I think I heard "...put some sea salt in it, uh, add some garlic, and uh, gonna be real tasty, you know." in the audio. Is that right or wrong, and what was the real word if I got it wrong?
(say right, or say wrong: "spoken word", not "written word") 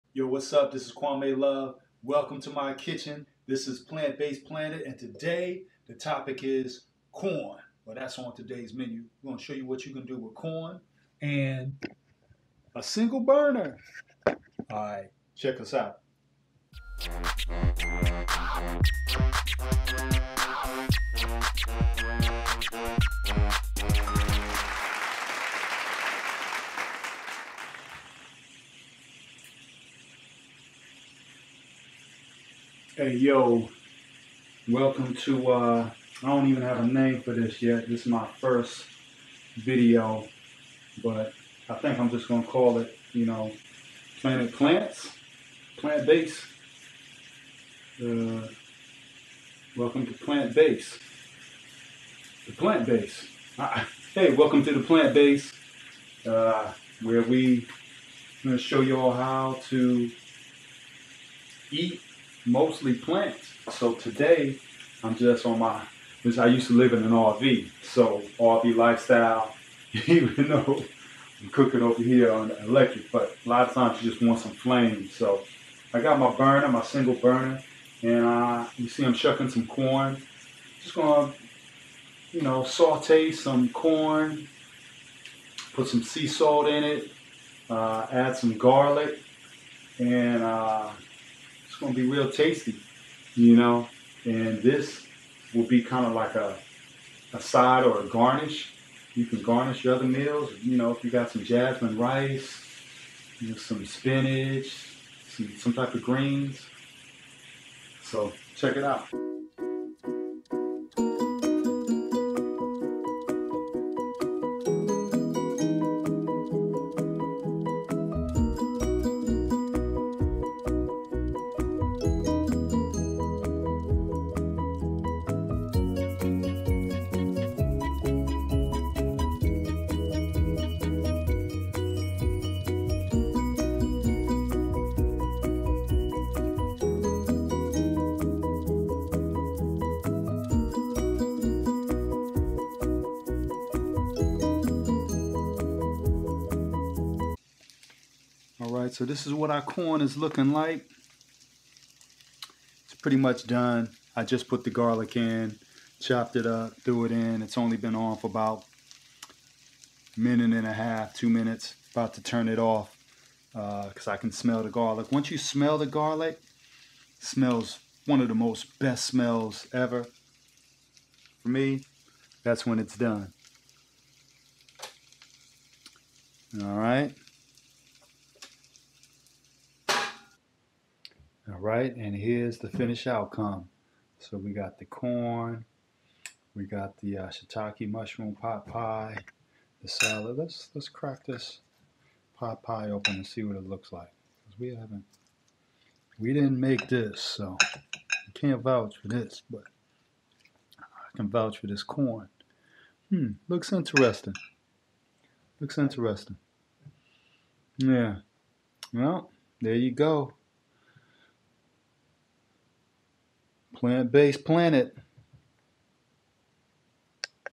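right.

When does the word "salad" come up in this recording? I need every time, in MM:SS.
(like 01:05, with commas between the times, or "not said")
03:09.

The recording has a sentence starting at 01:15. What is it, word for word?
So I got my burner, my single burner, and I, you see I'm shucking some corn.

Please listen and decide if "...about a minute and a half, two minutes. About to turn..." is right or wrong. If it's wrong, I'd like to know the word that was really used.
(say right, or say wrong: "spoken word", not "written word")
right.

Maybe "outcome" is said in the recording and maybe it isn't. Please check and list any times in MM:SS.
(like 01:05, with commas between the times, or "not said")
03:03.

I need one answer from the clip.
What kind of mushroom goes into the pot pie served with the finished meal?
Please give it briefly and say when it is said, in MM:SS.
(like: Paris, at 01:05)
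shiitake, at 03:07.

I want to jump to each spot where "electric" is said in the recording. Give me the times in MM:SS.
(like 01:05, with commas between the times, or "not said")
01:12.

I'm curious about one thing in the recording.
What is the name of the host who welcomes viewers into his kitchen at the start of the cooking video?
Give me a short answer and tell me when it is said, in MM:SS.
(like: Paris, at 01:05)
Kwame Love, at 00:00.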